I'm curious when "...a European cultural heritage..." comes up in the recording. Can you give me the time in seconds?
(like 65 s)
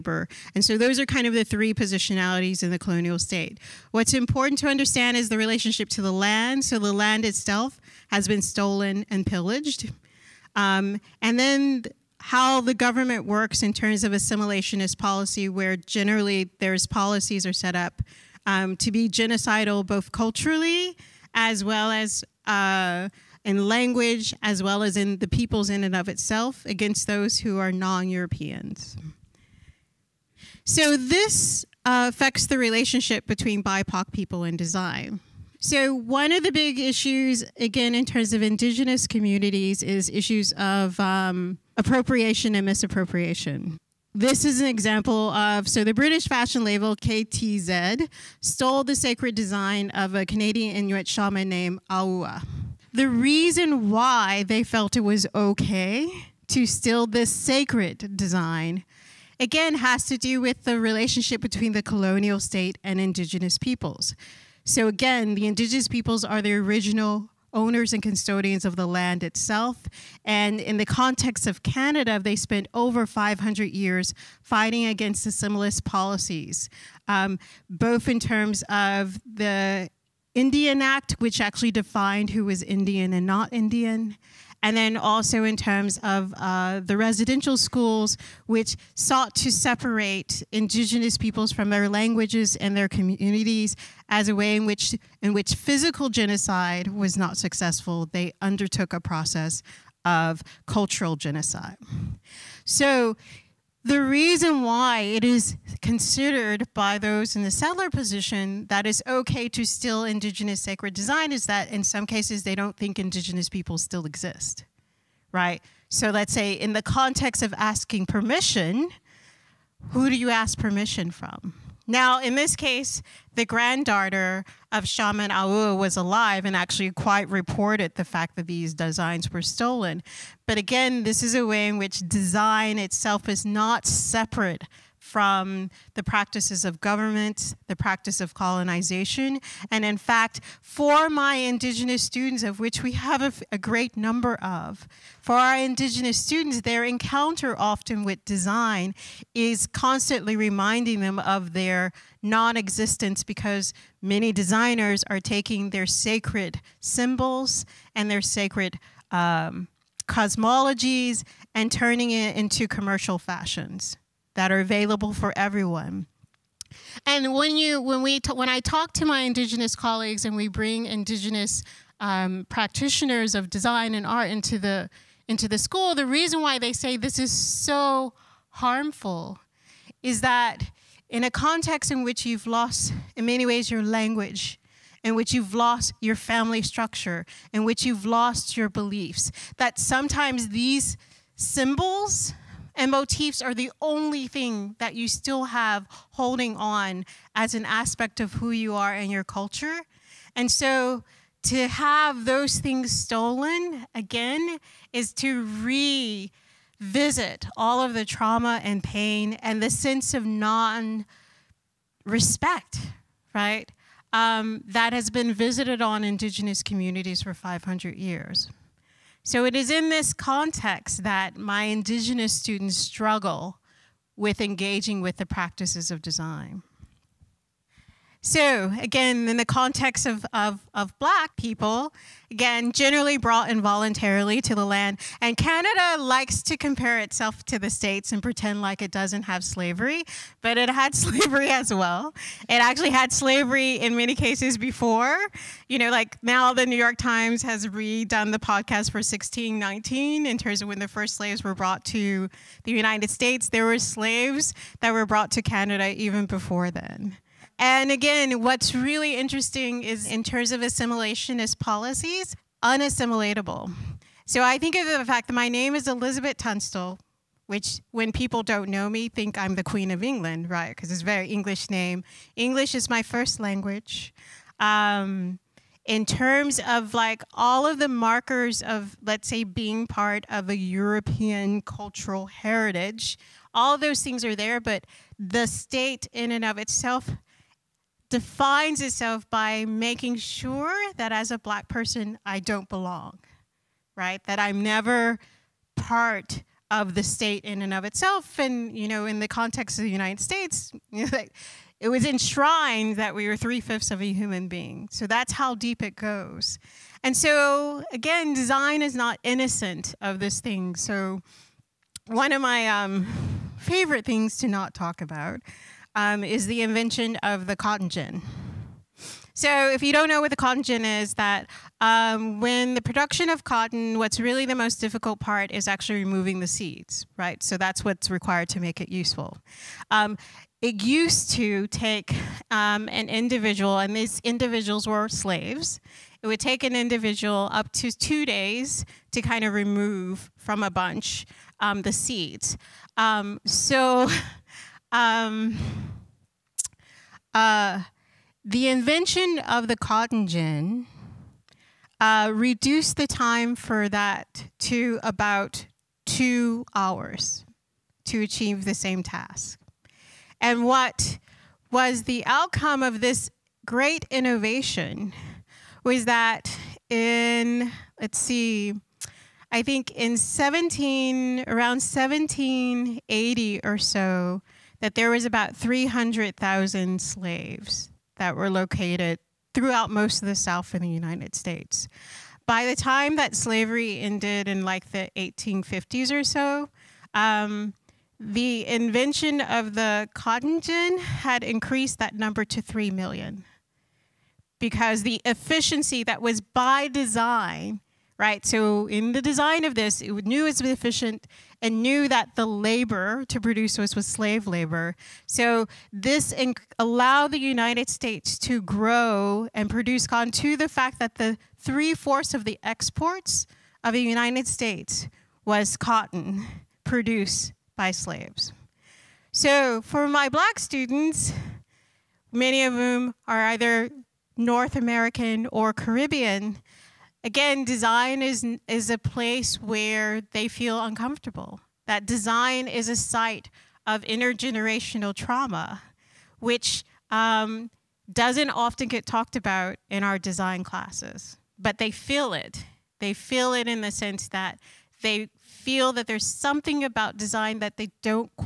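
280 s.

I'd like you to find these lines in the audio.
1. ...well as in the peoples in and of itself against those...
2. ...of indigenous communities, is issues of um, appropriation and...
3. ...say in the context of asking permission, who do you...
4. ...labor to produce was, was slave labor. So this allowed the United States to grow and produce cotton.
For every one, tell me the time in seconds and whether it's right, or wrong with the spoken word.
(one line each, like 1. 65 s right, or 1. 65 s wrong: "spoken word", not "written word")
1. 24 s right
2. 38 s right
3. 116 s right
4. 402 s right.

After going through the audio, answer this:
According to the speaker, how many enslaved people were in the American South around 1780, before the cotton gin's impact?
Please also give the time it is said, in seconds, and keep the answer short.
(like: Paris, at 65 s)
300,000, at 375 s.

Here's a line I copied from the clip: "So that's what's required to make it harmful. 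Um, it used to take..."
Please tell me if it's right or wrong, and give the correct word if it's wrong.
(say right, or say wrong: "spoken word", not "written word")
wrong: "useful", not "harmful".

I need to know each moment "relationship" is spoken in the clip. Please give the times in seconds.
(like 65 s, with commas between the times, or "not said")
5 s, 32 s, 60 s.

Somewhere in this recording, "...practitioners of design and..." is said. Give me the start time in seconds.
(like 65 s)
172 s.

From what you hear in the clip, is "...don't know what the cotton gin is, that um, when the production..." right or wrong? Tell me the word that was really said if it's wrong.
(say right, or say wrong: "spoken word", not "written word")
right.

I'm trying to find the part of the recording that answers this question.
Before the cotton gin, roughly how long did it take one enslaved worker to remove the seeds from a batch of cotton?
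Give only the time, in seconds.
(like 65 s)
337 s.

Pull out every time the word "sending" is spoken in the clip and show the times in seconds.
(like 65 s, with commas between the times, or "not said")
not said.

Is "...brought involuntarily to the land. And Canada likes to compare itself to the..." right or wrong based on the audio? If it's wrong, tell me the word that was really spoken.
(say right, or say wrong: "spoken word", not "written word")
right.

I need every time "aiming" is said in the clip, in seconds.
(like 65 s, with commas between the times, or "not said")
not said.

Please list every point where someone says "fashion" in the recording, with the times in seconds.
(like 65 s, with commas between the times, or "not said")
46 s, 163 s.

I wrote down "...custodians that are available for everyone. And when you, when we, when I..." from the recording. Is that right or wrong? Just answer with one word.
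wrong.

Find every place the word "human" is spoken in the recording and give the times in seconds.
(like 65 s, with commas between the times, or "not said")
304 s.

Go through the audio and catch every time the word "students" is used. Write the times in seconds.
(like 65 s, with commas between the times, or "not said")
142 s, 146 s, 222 s, 420 s.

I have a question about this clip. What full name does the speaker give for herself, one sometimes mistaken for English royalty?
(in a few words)
Elizabeth Tunstall.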